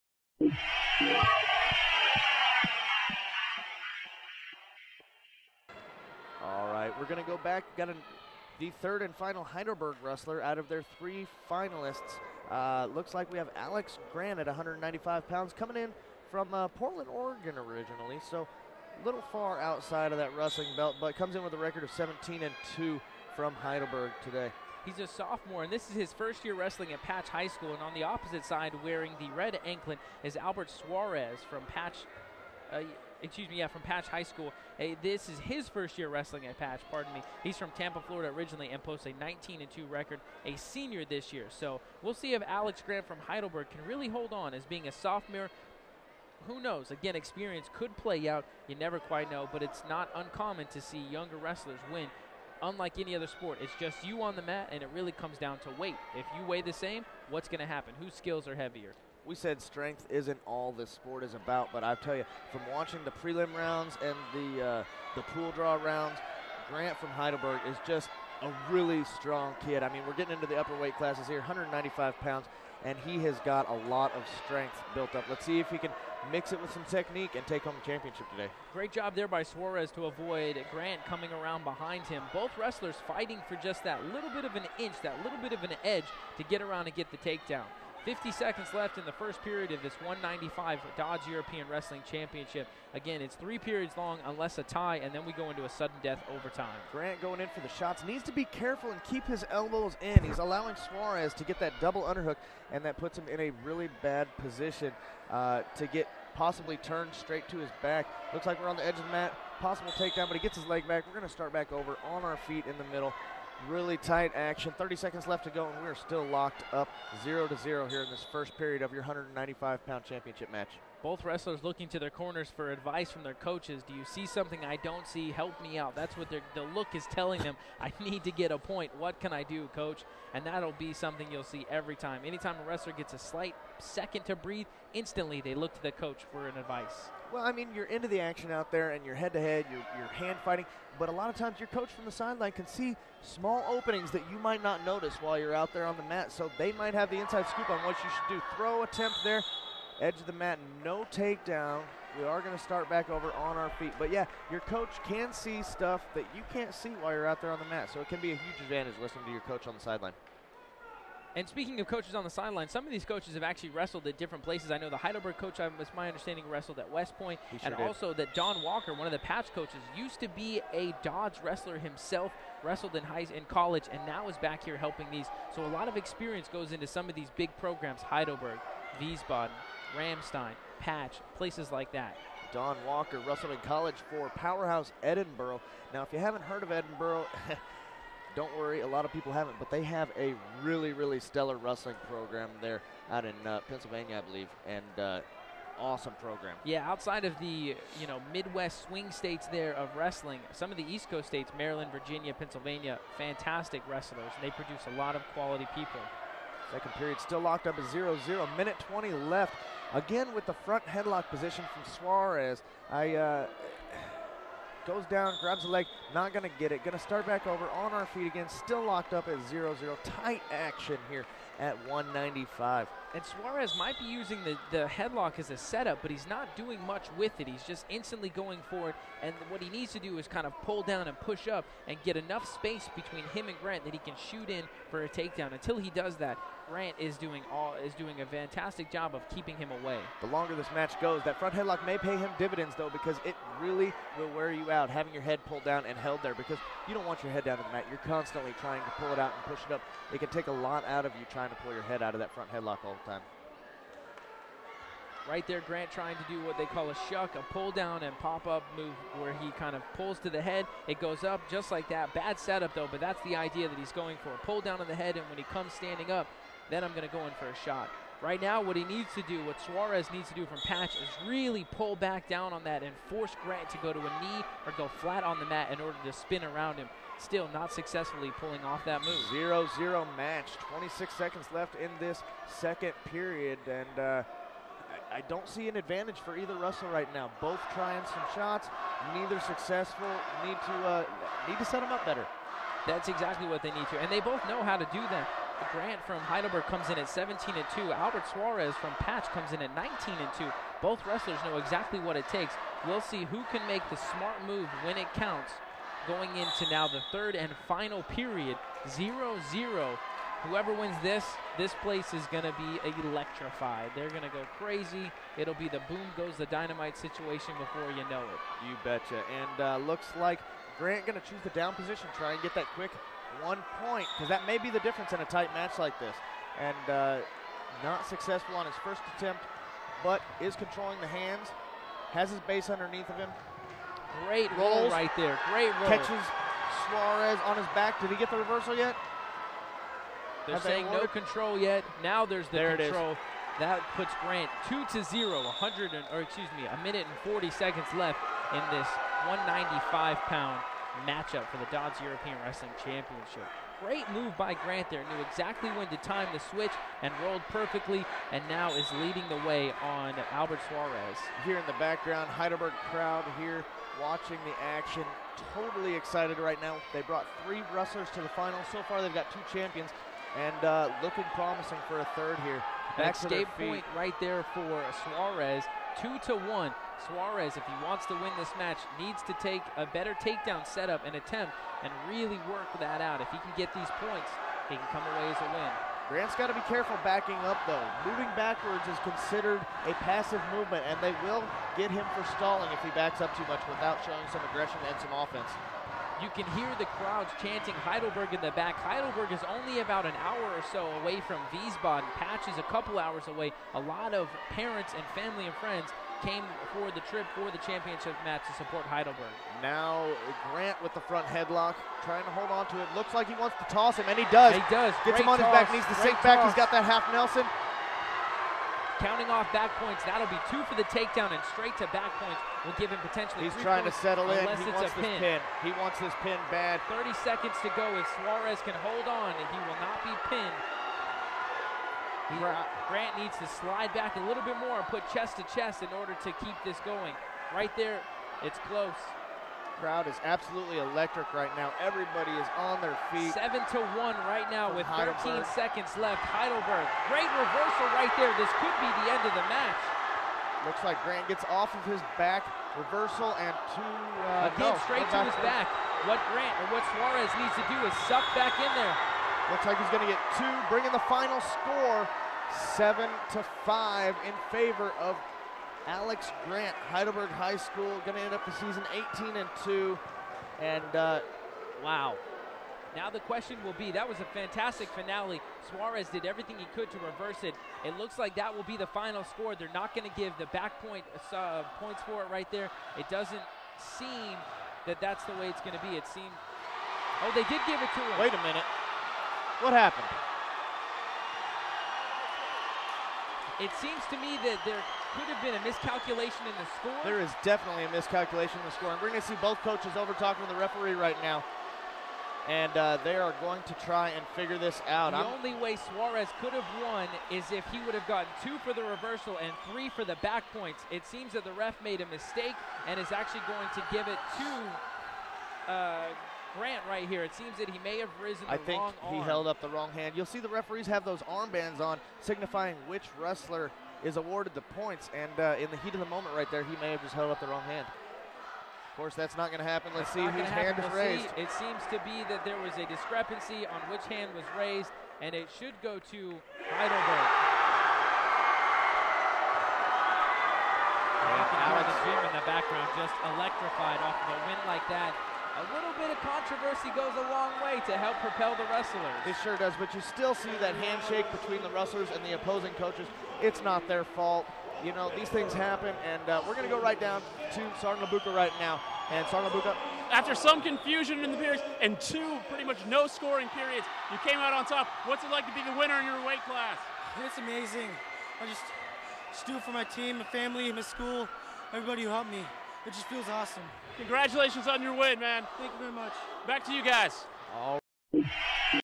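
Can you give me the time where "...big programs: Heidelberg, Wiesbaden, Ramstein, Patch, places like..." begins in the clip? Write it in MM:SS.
02:57.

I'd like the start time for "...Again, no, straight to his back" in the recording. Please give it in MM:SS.
07:34.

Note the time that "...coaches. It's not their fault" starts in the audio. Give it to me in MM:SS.
09:12.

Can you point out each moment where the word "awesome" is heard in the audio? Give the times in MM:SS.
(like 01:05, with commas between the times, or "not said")
03:15, 09:33.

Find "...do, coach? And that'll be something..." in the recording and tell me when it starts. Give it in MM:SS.
02:09.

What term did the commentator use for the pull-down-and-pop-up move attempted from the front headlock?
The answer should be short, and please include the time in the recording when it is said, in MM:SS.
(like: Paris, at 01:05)
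shuck, at 04:17.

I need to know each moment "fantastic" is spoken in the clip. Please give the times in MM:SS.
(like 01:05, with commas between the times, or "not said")
03:23, 03:58, 07:54.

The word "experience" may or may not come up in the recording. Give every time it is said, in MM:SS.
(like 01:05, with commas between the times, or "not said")
00:47, 02:55.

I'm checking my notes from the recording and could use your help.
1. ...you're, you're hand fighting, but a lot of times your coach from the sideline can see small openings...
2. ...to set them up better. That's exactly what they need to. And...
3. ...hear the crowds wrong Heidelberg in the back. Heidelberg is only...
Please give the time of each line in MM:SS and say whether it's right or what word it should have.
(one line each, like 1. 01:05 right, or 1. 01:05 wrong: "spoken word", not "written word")
1. 02:19 right
2. 04:51 right
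3. 06:36 wrong: "chanting", not "wrong".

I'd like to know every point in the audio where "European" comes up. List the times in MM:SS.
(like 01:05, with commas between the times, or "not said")
01:31, 05:52.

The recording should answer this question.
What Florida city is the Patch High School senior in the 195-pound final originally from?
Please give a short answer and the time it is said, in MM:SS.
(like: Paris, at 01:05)
Tampa, at 00:37.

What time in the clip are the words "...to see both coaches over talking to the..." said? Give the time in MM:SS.
08:19.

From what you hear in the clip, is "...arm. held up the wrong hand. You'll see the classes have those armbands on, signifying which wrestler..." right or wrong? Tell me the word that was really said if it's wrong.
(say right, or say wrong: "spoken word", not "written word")
wrong: "referees", not "classes".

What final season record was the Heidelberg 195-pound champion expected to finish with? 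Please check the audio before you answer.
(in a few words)
18 and 2.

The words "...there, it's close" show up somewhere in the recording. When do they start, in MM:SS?
07:17.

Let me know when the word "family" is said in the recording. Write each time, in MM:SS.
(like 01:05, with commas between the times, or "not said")
06:45, 09:30.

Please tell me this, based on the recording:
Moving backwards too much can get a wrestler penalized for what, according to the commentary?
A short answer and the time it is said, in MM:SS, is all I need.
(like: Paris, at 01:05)
stalling, at 06:32.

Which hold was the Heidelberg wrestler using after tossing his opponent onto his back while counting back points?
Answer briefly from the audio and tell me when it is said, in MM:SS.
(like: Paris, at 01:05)
half Nelson, at 06:56.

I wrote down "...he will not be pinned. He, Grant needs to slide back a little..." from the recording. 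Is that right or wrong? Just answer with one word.
right.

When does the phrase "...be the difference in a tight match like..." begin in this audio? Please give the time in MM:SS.
05:24.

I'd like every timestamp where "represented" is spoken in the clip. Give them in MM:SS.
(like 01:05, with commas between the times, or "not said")
not said.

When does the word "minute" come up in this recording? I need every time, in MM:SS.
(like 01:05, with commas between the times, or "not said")
03:28, 05:46, 08:08.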